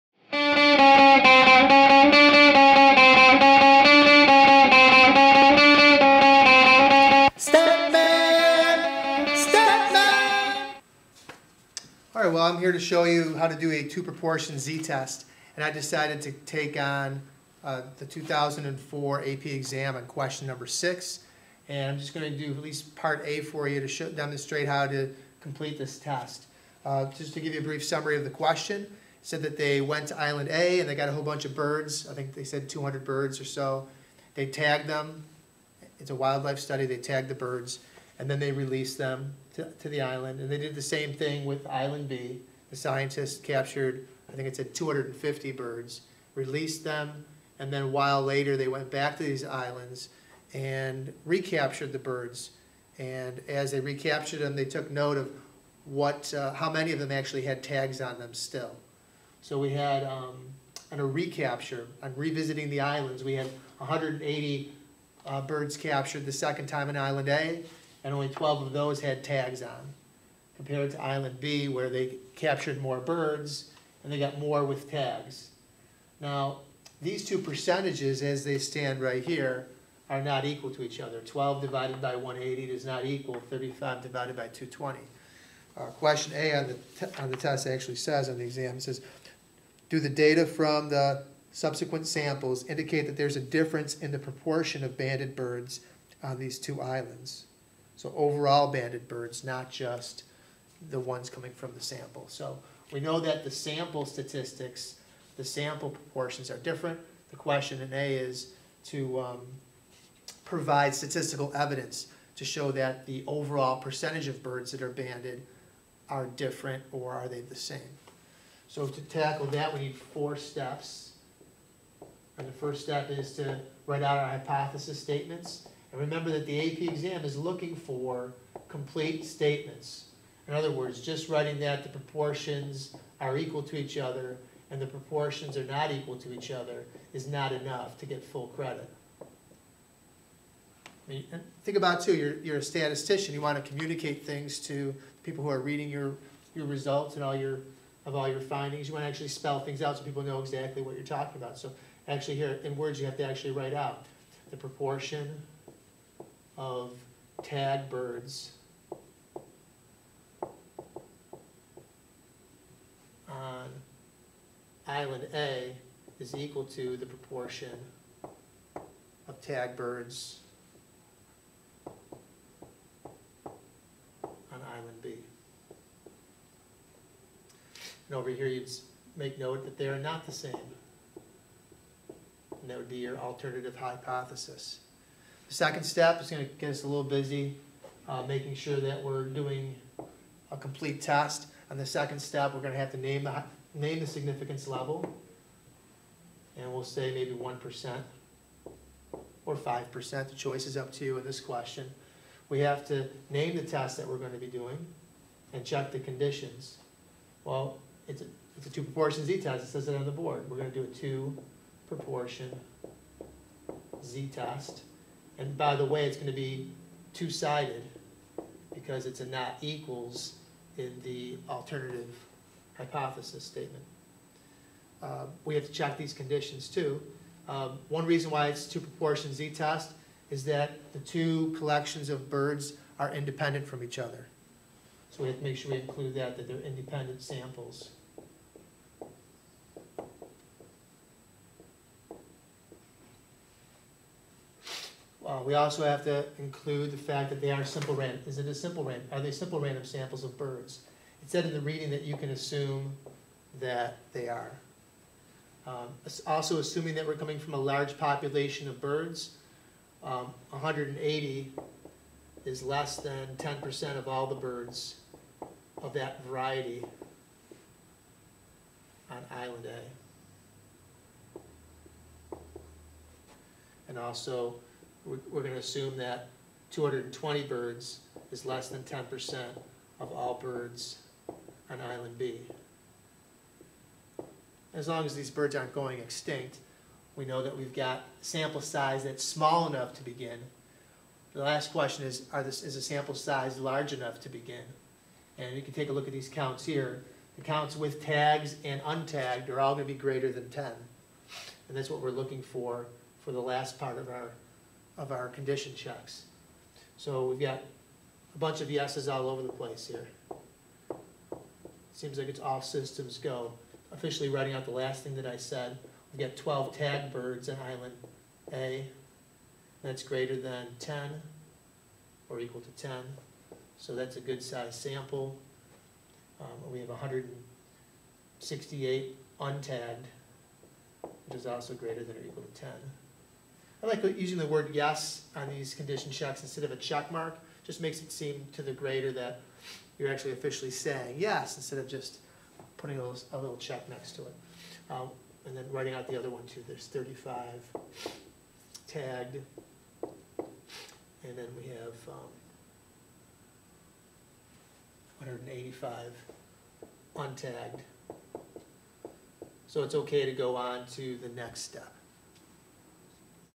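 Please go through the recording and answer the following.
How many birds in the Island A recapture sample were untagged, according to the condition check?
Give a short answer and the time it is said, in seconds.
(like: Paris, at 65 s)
168, at 326 s.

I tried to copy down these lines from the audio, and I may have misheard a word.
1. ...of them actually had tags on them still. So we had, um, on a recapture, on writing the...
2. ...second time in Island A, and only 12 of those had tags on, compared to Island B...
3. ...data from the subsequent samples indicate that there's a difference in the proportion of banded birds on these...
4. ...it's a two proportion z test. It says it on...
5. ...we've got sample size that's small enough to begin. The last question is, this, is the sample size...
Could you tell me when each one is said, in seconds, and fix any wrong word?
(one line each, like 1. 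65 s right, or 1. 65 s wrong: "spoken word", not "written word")
1. 56 s wrong: "revisiting", not "writing"
2. 66 s right
3. 90 s right
4. 208 s right
5. 287 s right.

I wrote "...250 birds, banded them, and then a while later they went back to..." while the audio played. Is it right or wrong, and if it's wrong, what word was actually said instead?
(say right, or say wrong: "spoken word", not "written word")
wrong: "released", not "banded".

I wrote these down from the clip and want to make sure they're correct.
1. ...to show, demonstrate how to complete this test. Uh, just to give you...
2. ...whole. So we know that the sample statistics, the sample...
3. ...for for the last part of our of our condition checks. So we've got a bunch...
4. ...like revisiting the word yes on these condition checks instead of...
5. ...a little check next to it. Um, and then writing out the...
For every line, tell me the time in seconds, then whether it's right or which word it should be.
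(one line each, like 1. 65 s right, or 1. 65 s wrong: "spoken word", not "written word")
1. 23 s right
2. 101 s wrong: "sample", not "whole"
3. 302 s right
4. 333 s wrong: "using", not "revisiting"
5. 343 s right.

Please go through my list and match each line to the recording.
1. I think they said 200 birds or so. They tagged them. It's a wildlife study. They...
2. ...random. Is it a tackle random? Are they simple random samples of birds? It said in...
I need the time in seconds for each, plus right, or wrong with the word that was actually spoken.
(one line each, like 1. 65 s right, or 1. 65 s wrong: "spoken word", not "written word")
1. 32 s right
2. 247 s wrong: "simple", not "tackle".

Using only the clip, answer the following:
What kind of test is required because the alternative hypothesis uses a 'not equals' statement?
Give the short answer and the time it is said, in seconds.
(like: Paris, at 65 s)
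two-sided, at 217 s.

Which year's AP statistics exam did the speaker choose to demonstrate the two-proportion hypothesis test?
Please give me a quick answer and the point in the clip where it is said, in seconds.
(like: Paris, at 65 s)
2004, at 18 s.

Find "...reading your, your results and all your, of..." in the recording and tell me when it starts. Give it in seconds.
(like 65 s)
145 s.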